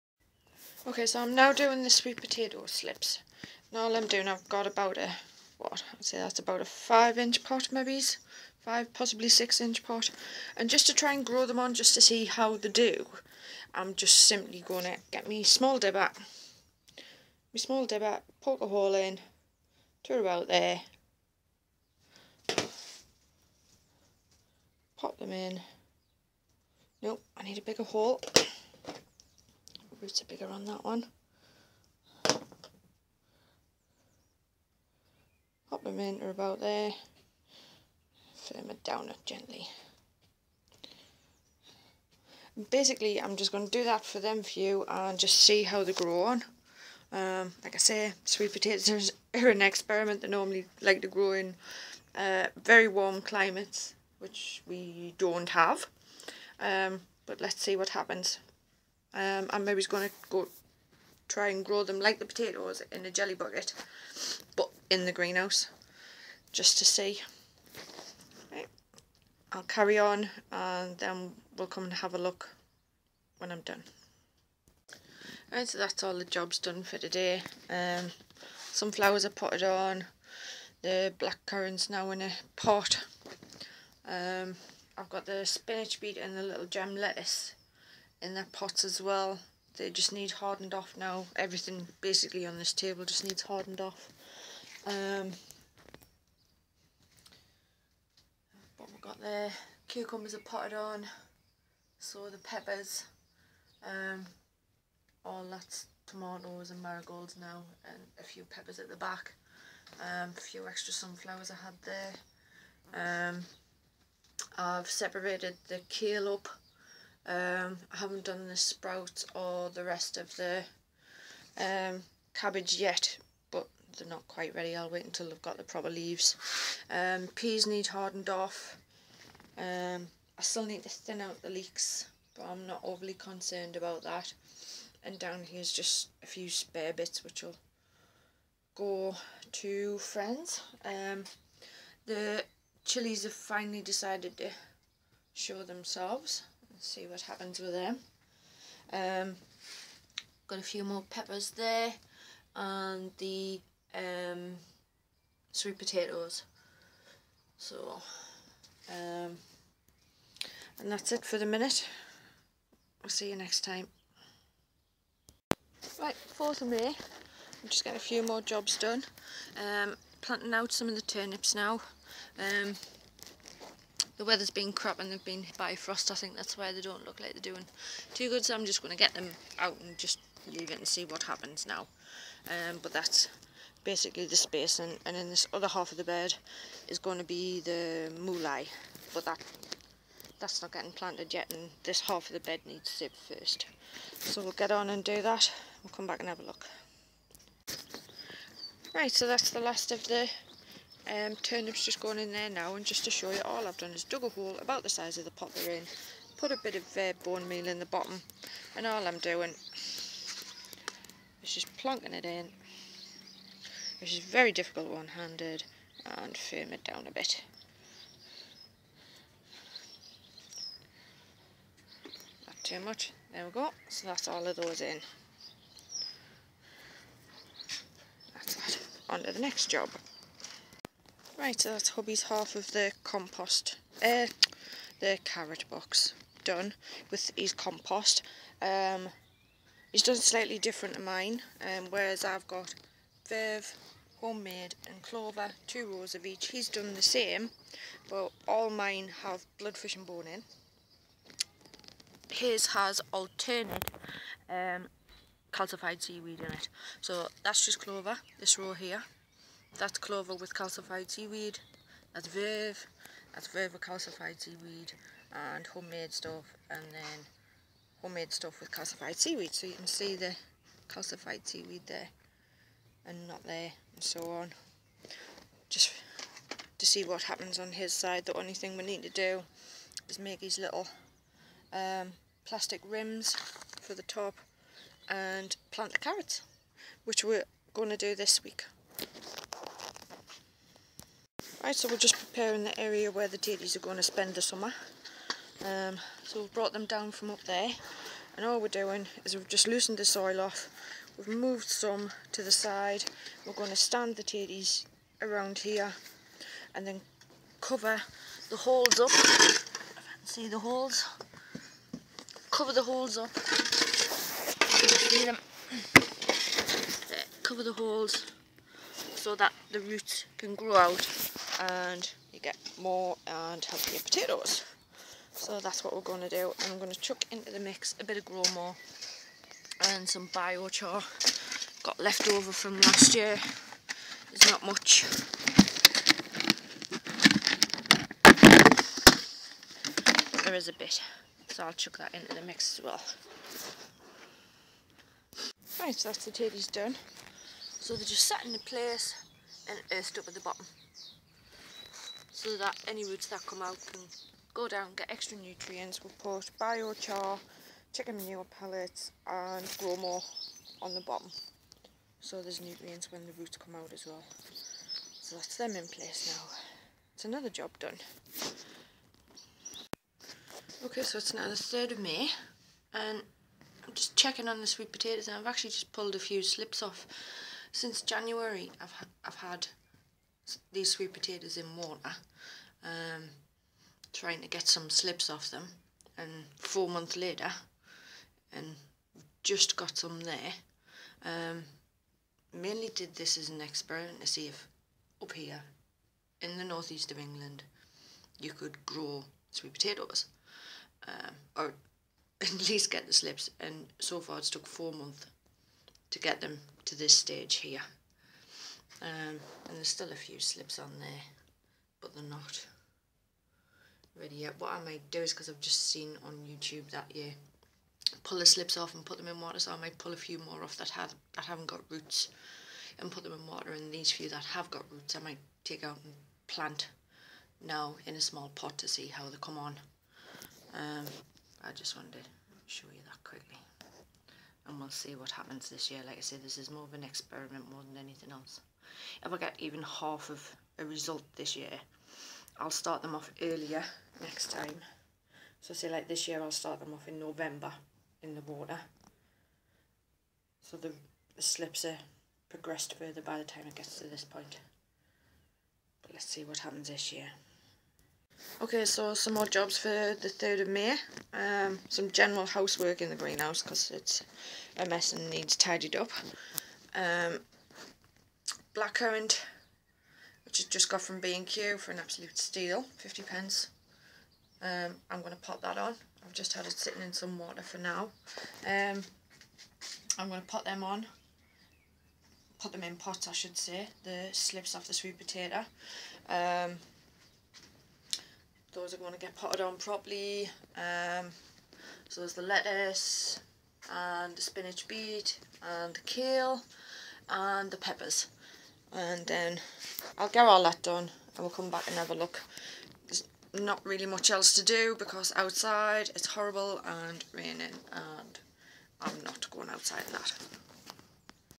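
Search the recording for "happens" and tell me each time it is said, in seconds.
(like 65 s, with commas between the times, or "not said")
57 s, 147 s, 181 s, 277 s, 435 s, 456 s.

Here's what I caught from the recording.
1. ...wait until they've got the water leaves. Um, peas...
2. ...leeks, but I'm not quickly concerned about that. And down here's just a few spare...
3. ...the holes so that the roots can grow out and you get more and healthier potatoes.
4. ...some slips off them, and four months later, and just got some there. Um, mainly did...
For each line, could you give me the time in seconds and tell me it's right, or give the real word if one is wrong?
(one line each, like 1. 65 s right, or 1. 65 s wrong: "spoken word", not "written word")
1. 124 s wrong: "proper", not "water"
2. 131 s wrong: "overly", not "quickly"
3. 317 s right
4. 384 s right.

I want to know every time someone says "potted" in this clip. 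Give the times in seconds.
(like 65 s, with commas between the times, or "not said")
79 s, 100 s, 489 s.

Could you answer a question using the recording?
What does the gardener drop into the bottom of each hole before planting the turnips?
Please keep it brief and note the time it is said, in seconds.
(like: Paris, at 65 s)
bone meal, at 207 s.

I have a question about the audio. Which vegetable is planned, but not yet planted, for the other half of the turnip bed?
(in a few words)
mooli.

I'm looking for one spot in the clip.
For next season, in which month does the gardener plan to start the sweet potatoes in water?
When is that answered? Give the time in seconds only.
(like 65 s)
447 s.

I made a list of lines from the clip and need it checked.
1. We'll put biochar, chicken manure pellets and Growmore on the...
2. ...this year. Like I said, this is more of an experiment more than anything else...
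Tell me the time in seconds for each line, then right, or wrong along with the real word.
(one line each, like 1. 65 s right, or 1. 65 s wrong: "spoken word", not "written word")
1. 356 s right
2. 435 s right.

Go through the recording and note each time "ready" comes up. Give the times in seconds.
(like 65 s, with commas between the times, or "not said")
124 s, 414 s.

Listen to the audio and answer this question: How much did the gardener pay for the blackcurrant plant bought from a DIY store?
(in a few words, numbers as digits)
50 pence.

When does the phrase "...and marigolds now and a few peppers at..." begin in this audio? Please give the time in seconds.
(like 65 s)
106 s.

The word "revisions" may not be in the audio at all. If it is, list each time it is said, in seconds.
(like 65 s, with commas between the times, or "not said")
not said.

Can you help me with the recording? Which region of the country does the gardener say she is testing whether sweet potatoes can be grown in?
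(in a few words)
northeast of England.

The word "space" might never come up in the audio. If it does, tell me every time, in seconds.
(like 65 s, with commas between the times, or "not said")
184 s.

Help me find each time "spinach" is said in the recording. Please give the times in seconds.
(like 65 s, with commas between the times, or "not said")
85 s, 494 s.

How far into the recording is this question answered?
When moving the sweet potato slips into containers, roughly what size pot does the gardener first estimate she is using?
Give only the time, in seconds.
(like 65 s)
6 s.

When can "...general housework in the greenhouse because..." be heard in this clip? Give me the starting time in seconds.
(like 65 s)
462 s.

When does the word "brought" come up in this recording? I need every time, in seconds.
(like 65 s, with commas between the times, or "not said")
296 s.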